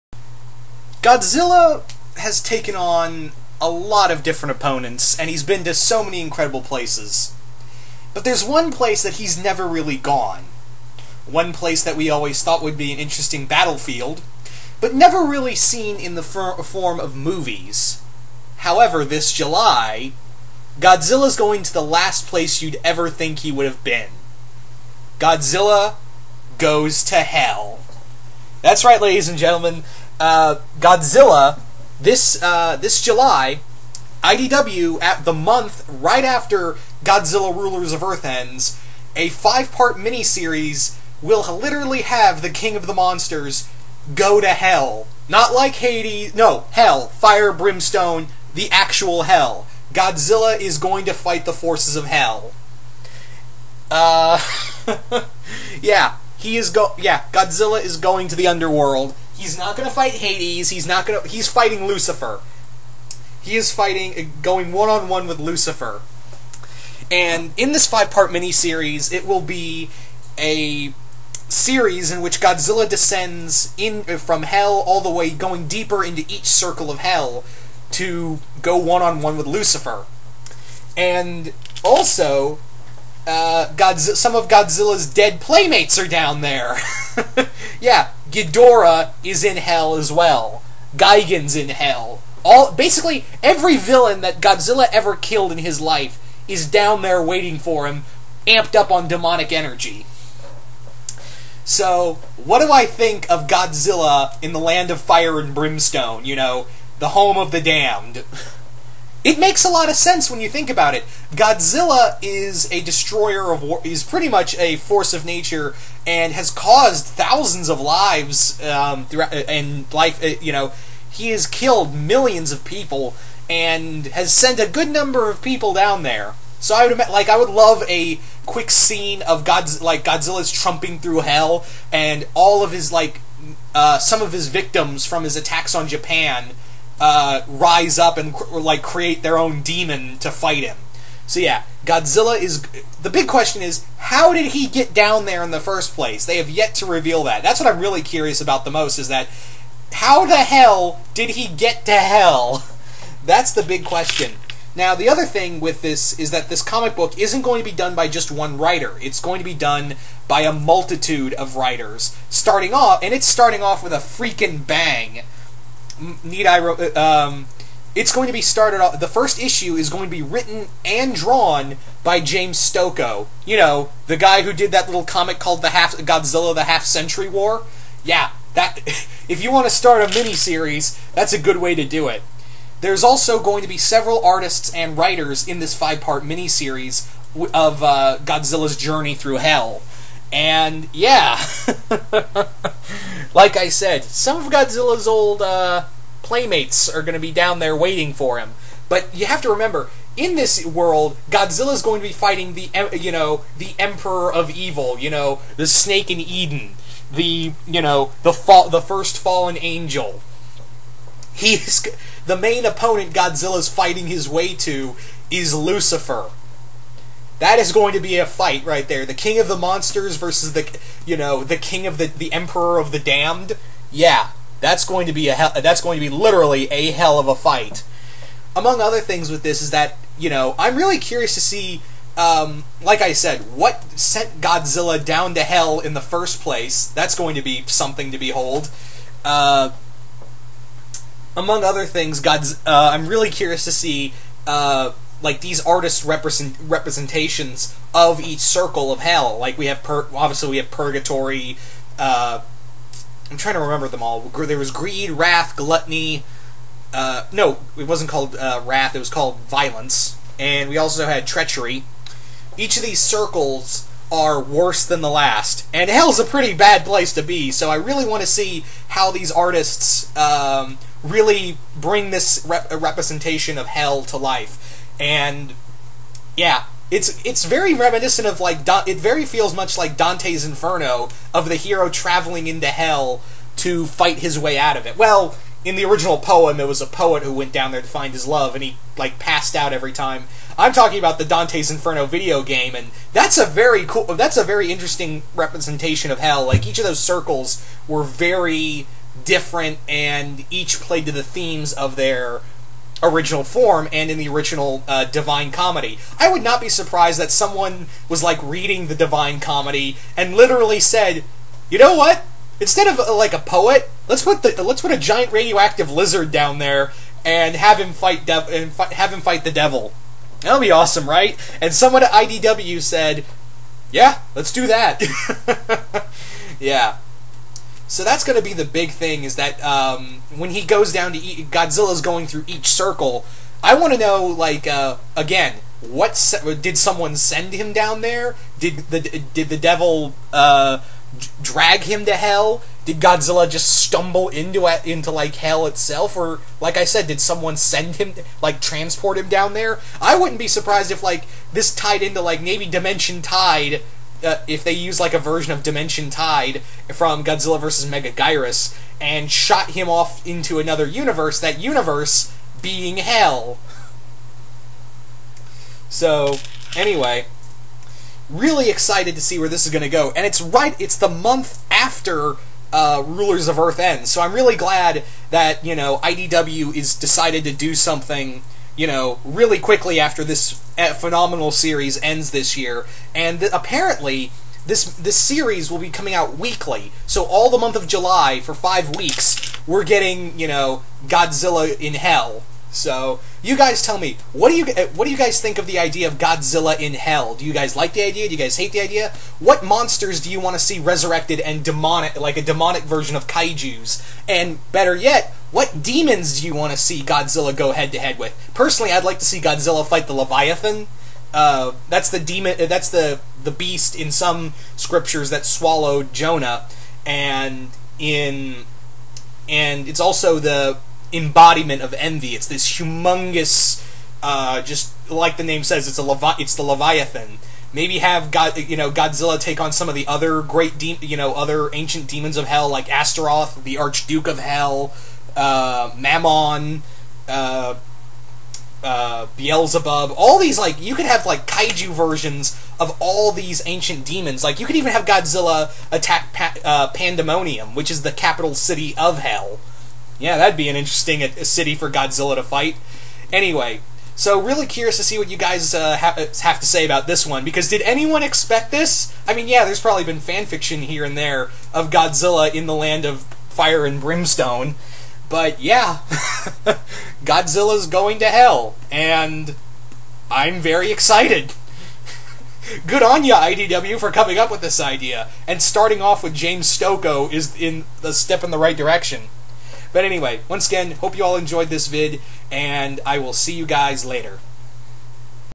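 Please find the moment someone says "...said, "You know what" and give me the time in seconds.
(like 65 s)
310 s.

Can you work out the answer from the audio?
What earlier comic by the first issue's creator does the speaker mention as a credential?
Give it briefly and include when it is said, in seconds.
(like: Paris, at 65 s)
Godzilla: The Half Century War, at 175 s.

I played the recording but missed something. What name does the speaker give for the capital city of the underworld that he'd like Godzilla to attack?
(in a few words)
Pandemonium.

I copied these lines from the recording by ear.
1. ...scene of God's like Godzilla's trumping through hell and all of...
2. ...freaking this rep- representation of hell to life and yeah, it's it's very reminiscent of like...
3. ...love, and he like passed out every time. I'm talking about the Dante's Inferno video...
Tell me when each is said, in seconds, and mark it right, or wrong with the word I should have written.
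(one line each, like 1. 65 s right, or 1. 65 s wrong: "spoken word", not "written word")
1. 128 s right
2. 271 s wrong: "bring", not "freaking"
3. 288 s right.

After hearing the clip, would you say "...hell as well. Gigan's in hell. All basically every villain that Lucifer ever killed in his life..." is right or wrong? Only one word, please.
wrong.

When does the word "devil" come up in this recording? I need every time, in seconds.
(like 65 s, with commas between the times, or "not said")
319 s, 339 s.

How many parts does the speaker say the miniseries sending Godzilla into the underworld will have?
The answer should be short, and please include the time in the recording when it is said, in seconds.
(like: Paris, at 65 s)
5, at 39 s.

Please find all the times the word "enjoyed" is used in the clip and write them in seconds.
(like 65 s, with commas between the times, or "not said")
481 s.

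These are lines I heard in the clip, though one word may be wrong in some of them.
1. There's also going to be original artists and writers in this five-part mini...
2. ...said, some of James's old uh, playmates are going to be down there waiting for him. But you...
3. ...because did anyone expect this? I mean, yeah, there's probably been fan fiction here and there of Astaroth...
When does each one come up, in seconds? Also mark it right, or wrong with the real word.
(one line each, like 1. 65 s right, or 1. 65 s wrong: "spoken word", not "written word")
1. 182 s wrong: "several", not "original"
2. 193 s wrong: "Godzilla", not "James"
3. 457 s wrong: "Godzilla", not "Astaroth".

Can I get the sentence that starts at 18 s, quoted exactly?
However, this July, Godzilla's going to the last place you'd ever think he would have been.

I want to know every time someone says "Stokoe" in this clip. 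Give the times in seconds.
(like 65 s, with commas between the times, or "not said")
172 s, 476 s.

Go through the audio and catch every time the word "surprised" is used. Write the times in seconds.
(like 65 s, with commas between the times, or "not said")
306 s, 350 s.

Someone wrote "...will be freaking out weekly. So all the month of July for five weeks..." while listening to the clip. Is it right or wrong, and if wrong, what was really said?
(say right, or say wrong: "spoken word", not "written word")
wrong: "coming", not "freaking".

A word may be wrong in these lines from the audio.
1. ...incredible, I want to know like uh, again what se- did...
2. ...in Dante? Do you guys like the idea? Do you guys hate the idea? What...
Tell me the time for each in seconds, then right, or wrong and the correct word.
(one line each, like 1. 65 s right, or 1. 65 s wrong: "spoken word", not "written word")
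1. 332 s wrong: "circle", not "incredible"
2. 396 s wrong: "Hell", not "Dante".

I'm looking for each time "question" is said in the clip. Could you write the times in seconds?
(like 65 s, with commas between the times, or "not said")
143 s, 153 s.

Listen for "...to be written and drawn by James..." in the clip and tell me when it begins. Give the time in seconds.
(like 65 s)
170 s.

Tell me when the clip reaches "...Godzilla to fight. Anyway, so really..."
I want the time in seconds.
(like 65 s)
451 s.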